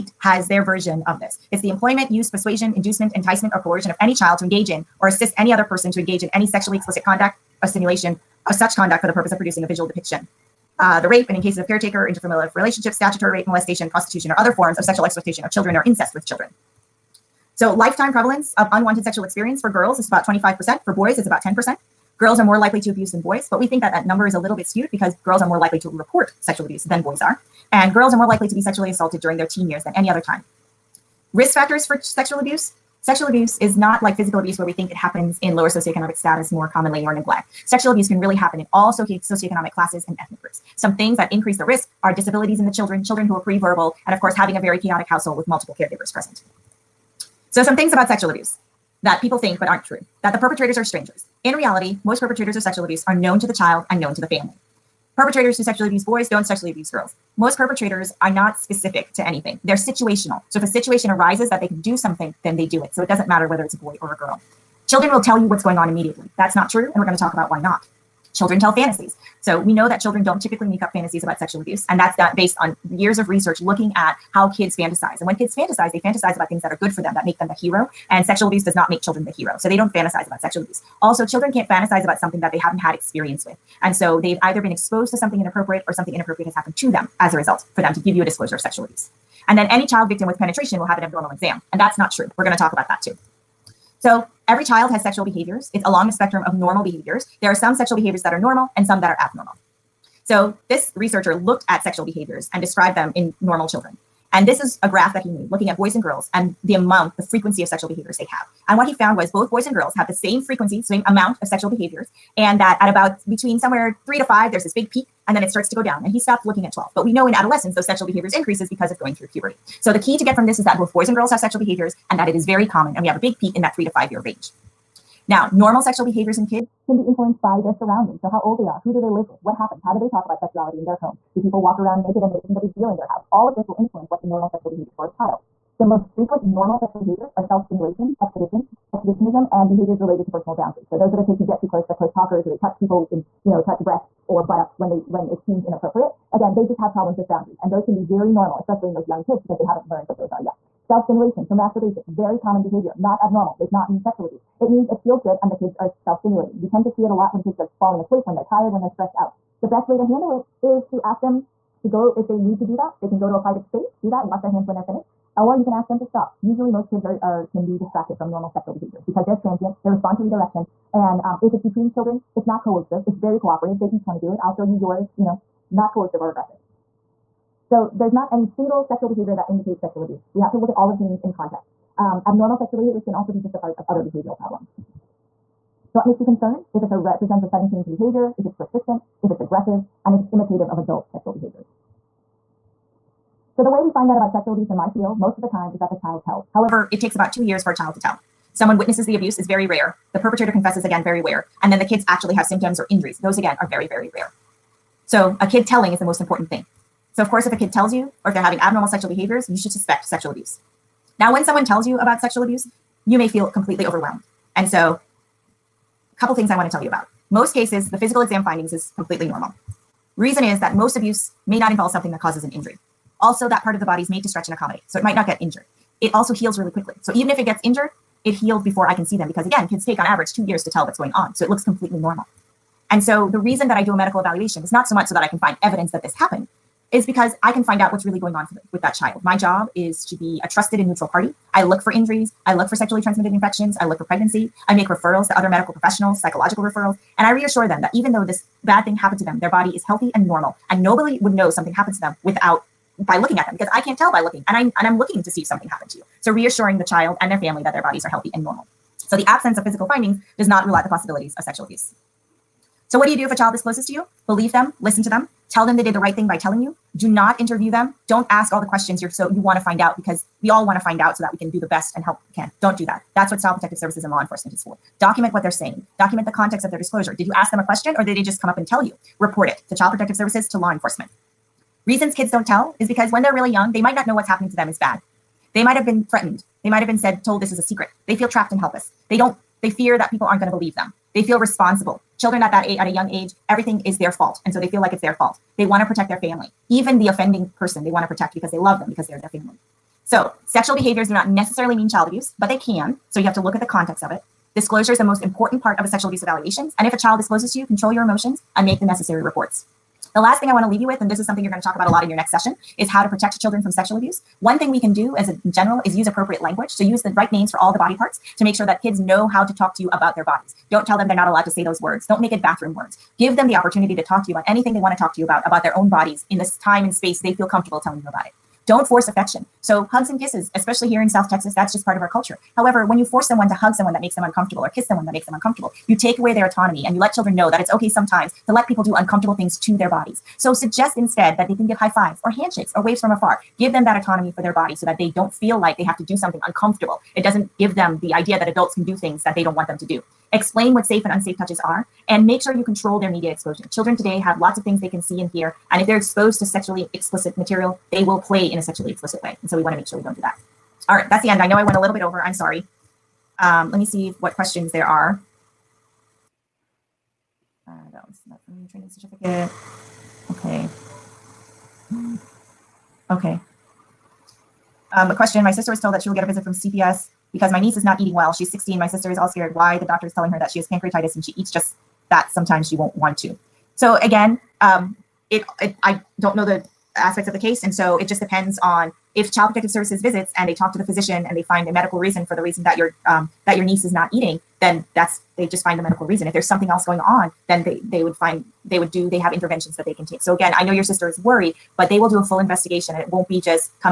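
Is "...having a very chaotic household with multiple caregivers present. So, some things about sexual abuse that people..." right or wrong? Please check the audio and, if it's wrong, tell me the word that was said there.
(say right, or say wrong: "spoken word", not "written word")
right.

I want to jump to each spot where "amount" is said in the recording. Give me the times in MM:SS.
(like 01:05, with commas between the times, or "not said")
01:46, 01:51.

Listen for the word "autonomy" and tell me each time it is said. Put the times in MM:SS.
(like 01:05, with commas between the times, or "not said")
05:36, 05:43.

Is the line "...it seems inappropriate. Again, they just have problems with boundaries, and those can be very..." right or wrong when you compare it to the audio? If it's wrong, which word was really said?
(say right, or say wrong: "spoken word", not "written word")
right.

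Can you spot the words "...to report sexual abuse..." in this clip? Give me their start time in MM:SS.
00:25.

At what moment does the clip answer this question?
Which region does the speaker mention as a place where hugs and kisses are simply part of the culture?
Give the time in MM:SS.
05:31.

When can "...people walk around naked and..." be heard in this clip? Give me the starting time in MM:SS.
02:11.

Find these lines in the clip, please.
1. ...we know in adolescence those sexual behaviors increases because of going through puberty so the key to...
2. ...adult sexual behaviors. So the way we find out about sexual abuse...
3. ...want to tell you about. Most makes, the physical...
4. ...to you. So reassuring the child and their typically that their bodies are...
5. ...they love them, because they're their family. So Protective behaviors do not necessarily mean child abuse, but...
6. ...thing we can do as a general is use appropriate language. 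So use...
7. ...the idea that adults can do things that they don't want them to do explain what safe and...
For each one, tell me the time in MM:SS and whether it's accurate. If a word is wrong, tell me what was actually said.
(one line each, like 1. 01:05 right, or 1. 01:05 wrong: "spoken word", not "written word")
1. 01:57 right
2. 03:10 right
3. 03:36 wrong: "cases", not "makes"
4. 04:15 wrong: "family", not "typically"
5. 04:58 wrong: "Sexual", not "Protective"
6. 05:14 right
7. 05:48 right.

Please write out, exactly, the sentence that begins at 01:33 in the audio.
So every child has sexual behaviors.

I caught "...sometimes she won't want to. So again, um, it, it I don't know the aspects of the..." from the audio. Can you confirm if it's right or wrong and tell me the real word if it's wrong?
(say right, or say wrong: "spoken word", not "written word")
right.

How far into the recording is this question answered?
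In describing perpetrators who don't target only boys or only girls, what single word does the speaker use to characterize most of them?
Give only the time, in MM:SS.
00:59.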